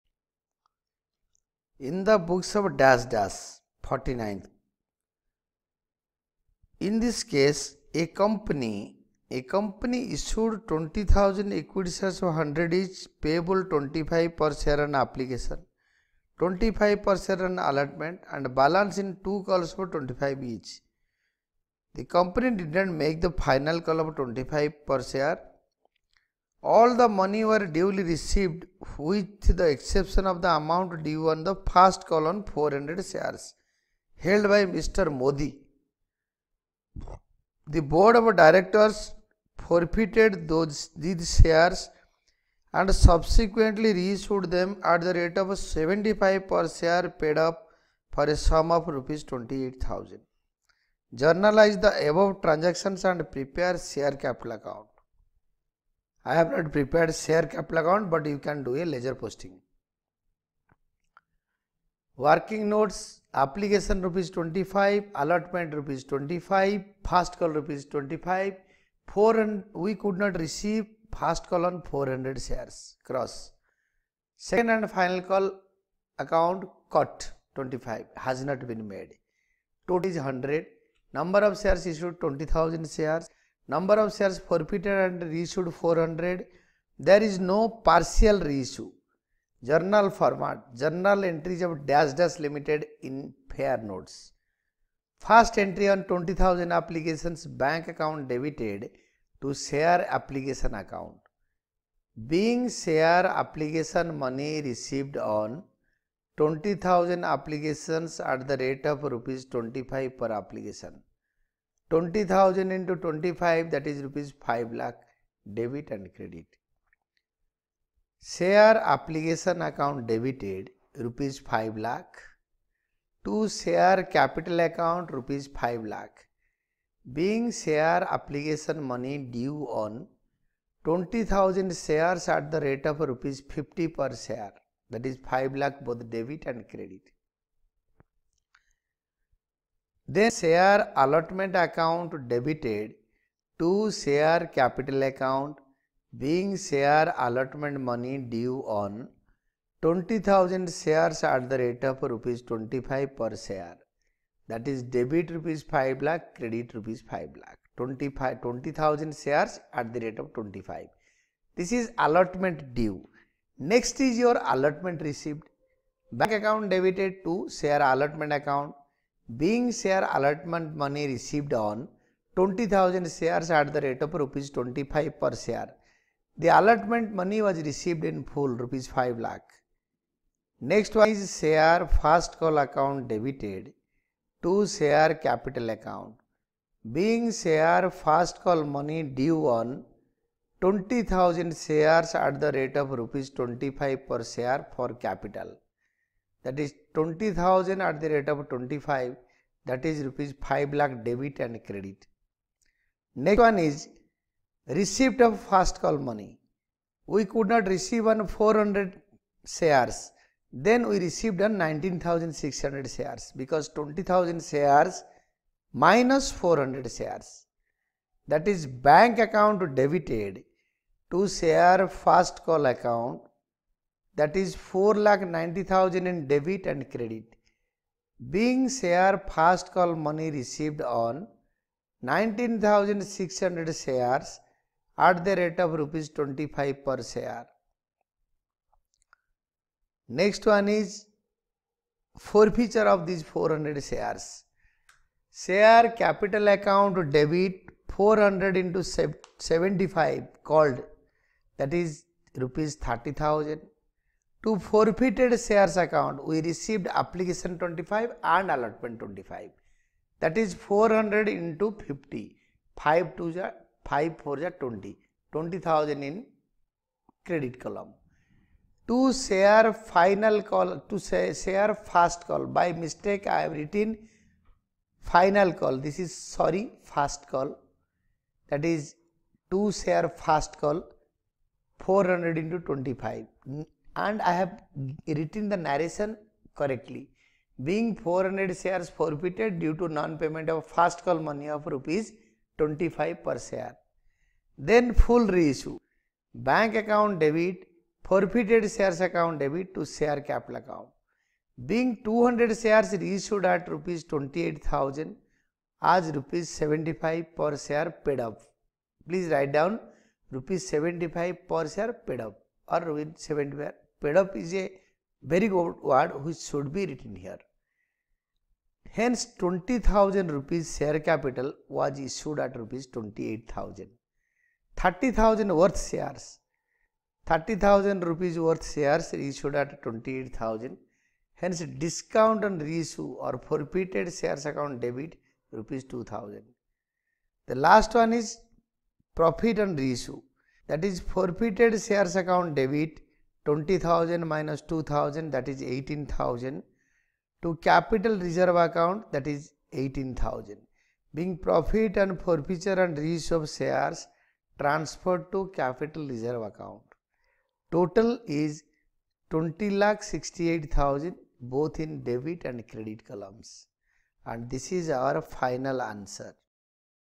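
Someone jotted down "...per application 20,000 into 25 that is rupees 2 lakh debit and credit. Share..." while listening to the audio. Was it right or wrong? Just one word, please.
wrong.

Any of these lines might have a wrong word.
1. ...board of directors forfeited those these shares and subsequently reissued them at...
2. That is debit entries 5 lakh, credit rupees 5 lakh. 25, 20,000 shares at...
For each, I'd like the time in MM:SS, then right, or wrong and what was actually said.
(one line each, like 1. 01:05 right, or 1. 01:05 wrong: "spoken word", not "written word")
1. 00:37 right
2. 02:34 wrong: "rupees", not "entries".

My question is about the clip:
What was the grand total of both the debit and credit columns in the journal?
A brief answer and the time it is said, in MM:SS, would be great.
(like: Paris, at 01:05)
Rs 20,68,000, at 05:59.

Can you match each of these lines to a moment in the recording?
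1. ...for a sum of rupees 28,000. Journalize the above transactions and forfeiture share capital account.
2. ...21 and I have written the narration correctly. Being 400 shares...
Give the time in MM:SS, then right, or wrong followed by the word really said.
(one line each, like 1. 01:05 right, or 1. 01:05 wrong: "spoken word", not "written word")
1. 00:48 wrong: "prepare", not "forfeiture"
2. 04:42 wrong: "25", not "21".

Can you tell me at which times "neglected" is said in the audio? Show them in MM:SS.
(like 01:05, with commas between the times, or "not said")
not said.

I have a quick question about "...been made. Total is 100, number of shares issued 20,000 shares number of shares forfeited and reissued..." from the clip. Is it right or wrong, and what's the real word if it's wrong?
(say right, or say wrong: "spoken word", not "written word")
right.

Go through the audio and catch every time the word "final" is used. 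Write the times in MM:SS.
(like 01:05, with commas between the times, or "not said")
00:23, 01:14, 04:29, 04:35, 06:05.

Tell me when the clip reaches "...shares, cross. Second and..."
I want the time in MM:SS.
01:12.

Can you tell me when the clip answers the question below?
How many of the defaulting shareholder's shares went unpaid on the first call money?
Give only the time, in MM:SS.
00:32.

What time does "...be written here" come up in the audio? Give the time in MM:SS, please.
05:16.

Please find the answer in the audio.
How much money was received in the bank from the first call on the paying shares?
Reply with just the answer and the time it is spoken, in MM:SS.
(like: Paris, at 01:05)
Rs 4,90,000, at 03:44.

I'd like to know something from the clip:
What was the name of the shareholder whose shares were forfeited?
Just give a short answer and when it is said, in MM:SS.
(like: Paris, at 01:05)
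Mr. Modi, at 00:34.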